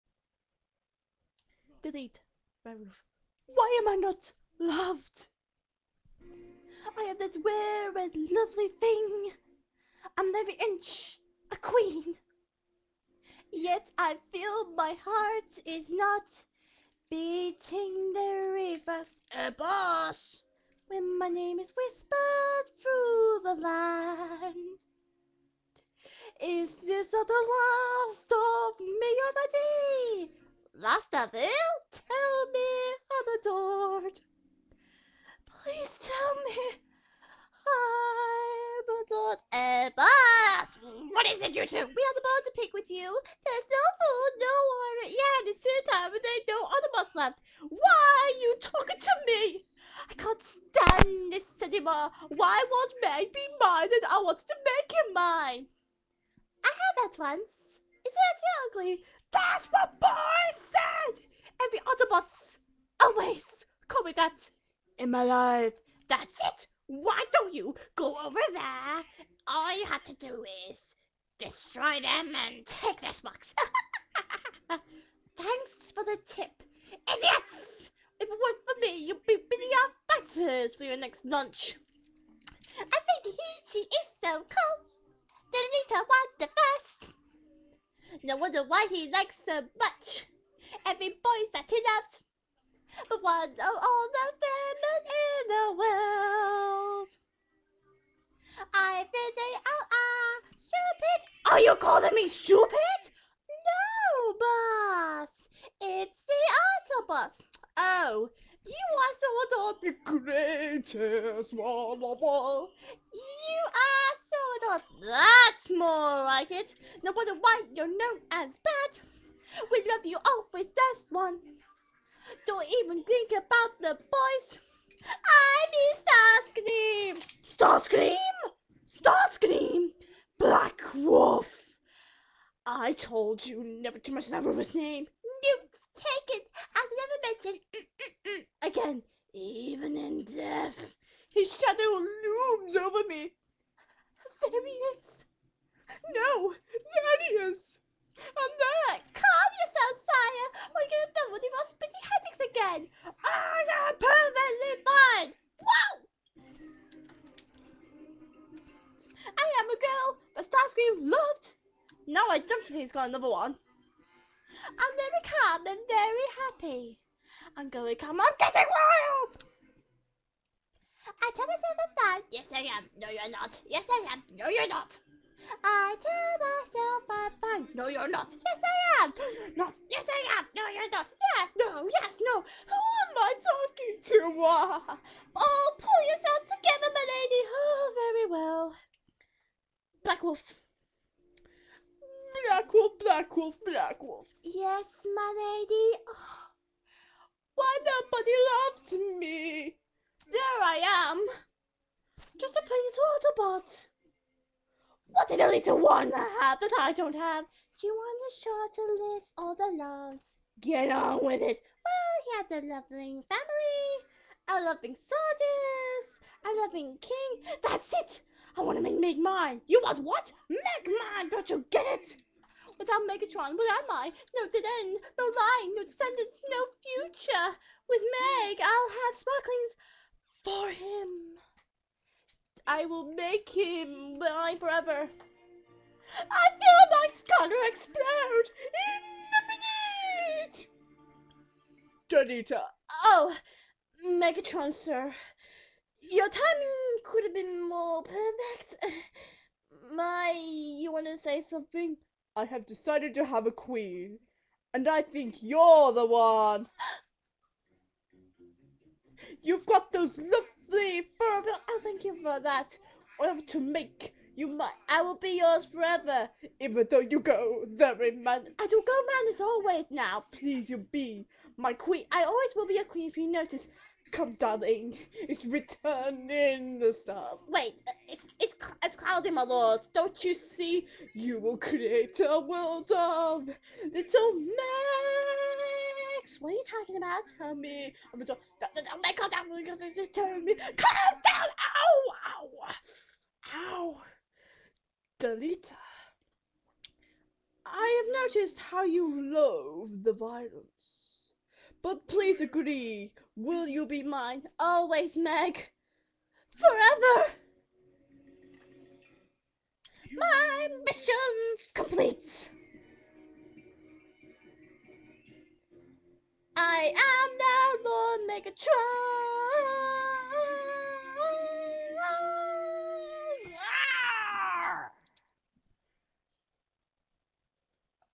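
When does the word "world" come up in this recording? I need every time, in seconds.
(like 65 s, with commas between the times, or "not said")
95 s, 282 s.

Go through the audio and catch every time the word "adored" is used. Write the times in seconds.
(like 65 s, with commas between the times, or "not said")
33 s, 39 s.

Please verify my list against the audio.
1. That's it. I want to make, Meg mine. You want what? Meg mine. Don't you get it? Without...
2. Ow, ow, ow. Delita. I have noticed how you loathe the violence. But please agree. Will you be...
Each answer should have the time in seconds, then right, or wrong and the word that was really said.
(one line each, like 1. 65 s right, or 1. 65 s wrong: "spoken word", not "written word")
1. 217 s right
2. 291 s right.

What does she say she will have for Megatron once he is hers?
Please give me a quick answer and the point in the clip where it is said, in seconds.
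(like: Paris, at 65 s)
sparklings, at 229 s.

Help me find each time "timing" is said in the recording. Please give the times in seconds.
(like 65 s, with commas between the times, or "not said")
246 s.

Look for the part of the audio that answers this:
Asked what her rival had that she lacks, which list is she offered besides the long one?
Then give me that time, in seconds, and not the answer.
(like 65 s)
208 s.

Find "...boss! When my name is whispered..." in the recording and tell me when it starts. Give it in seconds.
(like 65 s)
19 s.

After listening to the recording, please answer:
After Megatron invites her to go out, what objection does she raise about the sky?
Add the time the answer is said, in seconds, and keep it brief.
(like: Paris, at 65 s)
it's cloudy, at 278 s.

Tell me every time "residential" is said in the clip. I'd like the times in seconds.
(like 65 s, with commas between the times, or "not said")
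not said.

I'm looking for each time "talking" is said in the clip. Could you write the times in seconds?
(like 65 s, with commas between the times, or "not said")
48 s, 183 s, 286 s.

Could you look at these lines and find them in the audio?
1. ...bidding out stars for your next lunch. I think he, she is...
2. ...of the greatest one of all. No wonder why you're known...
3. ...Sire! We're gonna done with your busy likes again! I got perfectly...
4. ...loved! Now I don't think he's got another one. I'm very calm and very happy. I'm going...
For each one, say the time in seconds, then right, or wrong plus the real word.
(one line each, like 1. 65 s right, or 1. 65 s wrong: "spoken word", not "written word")
1. 79 s wrong: "fighters", not "stars"
2. 109 s right
3. 150 s wrong: "headaches", not "likes"
4. 161 s right.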